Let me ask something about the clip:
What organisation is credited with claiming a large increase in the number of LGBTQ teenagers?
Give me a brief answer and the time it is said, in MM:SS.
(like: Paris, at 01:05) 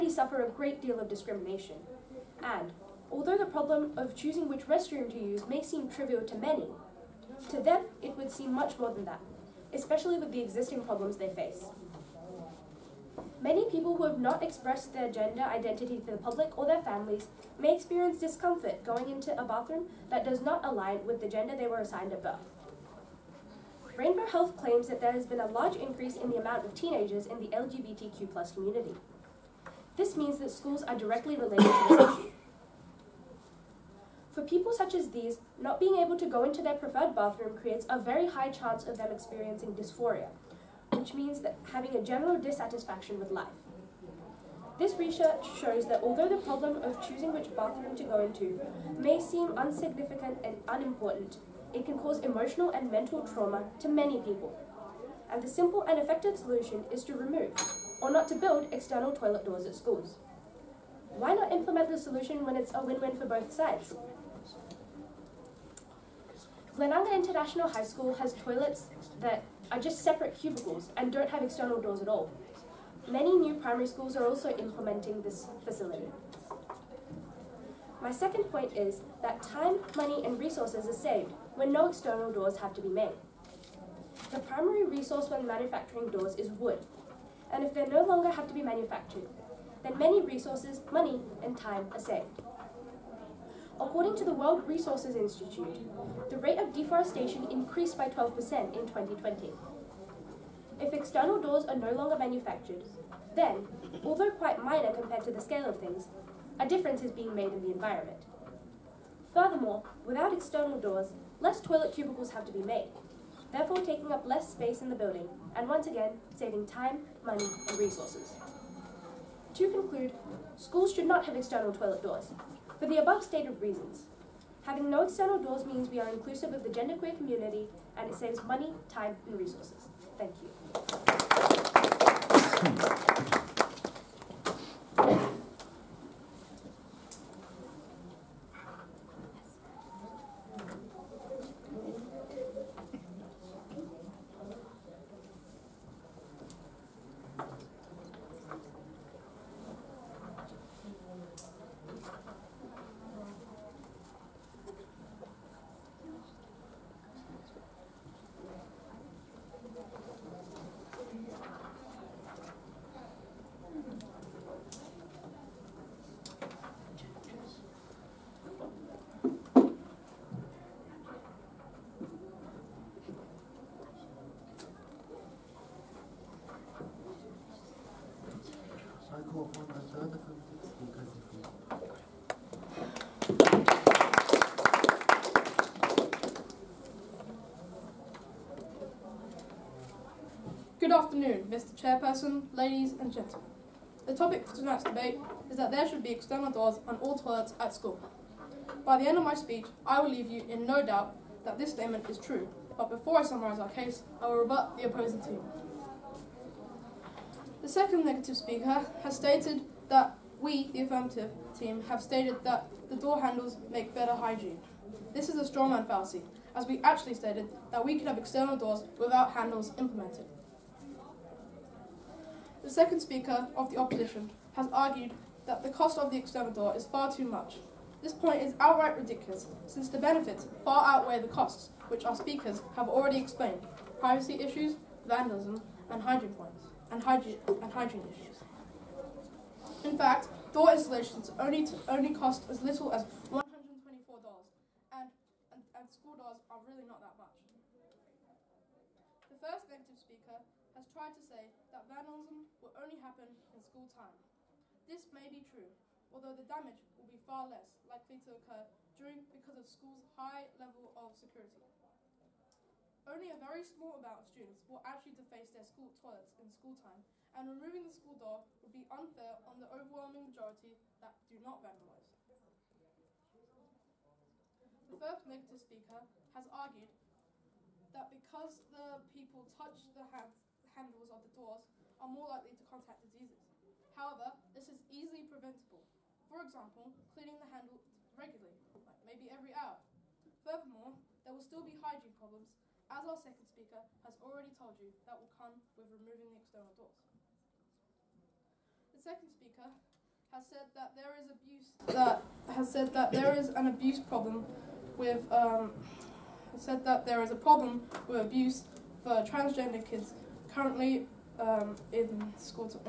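Rainbow Health, at 00:23.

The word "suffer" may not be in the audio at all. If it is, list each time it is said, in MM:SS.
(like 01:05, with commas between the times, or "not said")
00:00.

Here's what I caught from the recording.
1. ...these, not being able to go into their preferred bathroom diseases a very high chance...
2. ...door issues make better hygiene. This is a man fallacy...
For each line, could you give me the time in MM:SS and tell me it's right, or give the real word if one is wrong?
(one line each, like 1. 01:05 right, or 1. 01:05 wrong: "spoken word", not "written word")
1. 00:35 wrong: "creates", not "diseases"
2. 03:32 wrong: "handles", not "issues".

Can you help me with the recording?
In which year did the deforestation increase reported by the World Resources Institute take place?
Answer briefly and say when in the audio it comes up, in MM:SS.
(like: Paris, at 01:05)
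2020, at 01:38.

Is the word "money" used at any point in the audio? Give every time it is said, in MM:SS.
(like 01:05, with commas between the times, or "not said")
01:19, 01:30, 01:57, 02:08.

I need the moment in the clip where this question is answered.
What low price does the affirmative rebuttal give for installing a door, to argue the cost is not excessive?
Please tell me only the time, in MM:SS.
04:03.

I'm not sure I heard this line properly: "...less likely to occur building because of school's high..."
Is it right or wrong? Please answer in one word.
wrong.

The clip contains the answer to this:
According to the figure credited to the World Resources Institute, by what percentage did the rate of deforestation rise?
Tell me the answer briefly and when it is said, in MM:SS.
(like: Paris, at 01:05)
12%, at 01:38.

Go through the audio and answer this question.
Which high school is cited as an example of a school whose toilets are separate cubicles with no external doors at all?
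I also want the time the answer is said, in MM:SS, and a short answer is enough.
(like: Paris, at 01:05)
Glenunga International High School, at 01:06.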